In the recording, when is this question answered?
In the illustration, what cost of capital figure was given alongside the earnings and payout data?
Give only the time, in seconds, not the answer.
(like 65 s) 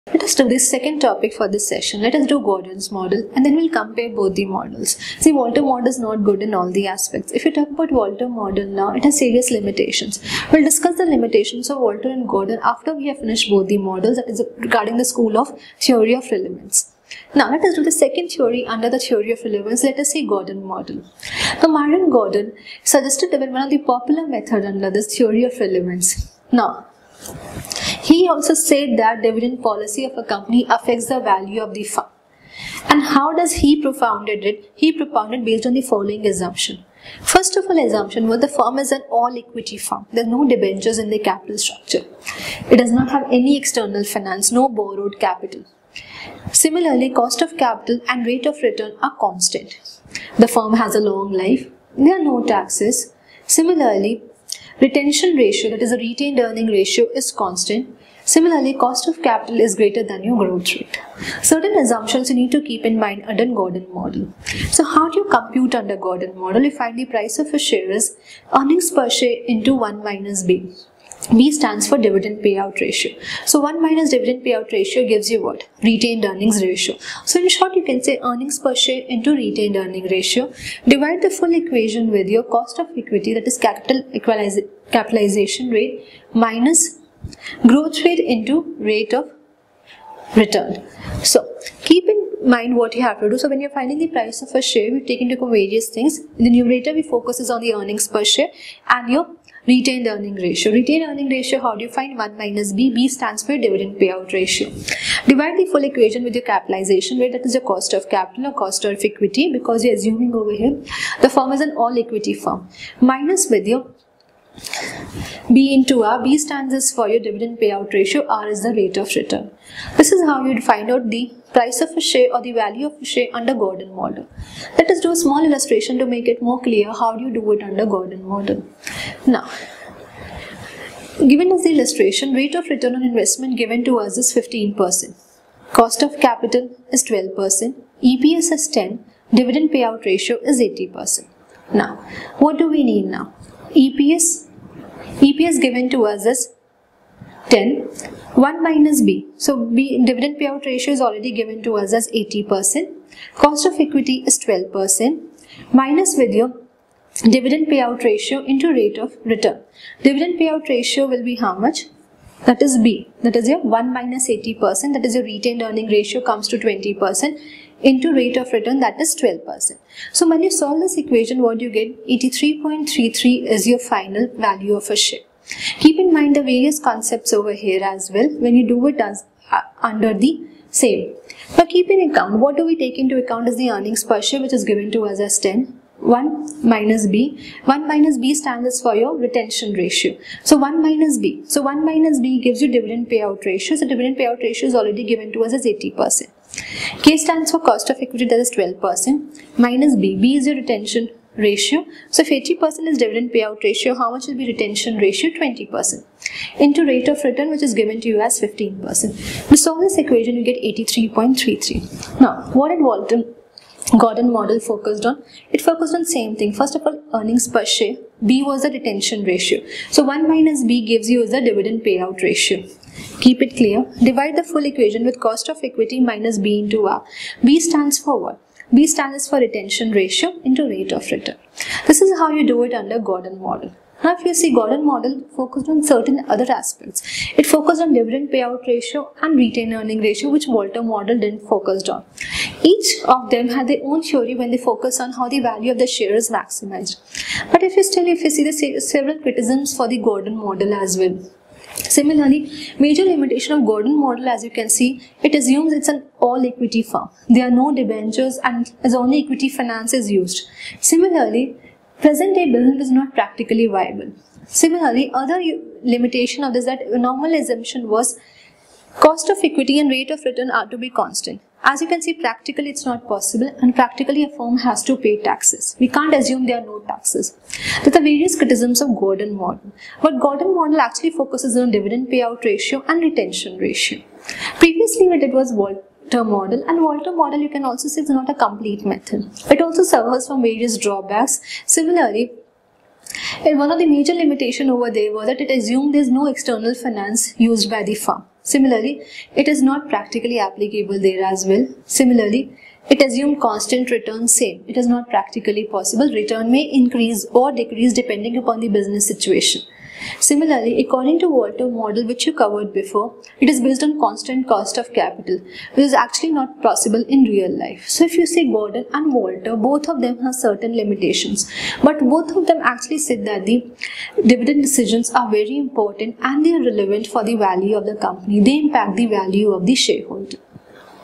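135 s.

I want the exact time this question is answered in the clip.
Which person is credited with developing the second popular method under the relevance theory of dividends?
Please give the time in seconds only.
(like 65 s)
21 s.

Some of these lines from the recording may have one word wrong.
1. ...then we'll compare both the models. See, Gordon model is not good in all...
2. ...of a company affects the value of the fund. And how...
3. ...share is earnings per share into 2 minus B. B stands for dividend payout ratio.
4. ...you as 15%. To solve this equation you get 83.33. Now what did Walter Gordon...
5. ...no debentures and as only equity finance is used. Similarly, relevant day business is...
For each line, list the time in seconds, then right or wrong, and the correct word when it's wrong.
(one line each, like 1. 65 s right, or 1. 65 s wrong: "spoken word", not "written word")
1. 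3 s wrong: "Walter", not "Gordon"
2. 30 s right
3. 67 s wrong: "1", not "2"
4. 208 s right
5. 257 s wrong: "present", not "relevant".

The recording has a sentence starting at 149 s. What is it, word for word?
So B dividend payout ratio is already given to us as 80%.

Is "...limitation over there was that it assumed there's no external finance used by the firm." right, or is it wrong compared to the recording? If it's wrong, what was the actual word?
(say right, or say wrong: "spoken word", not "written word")
right.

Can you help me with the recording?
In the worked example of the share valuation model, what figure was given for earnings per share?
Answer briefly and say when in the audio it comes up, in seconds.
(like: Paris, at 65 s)
10, at 138 s.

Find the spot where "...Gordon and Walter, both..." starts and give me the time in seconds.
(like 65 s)
318 s.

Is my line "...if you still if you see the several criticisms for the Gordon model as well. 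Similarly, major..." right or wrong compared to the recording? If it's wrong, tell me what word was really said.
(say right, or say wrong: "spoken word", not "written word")
right.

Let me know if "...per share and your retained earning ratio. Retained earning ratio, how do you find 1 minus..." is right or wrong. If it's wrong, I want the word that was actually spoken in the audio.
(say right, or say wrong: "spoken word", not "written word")
right.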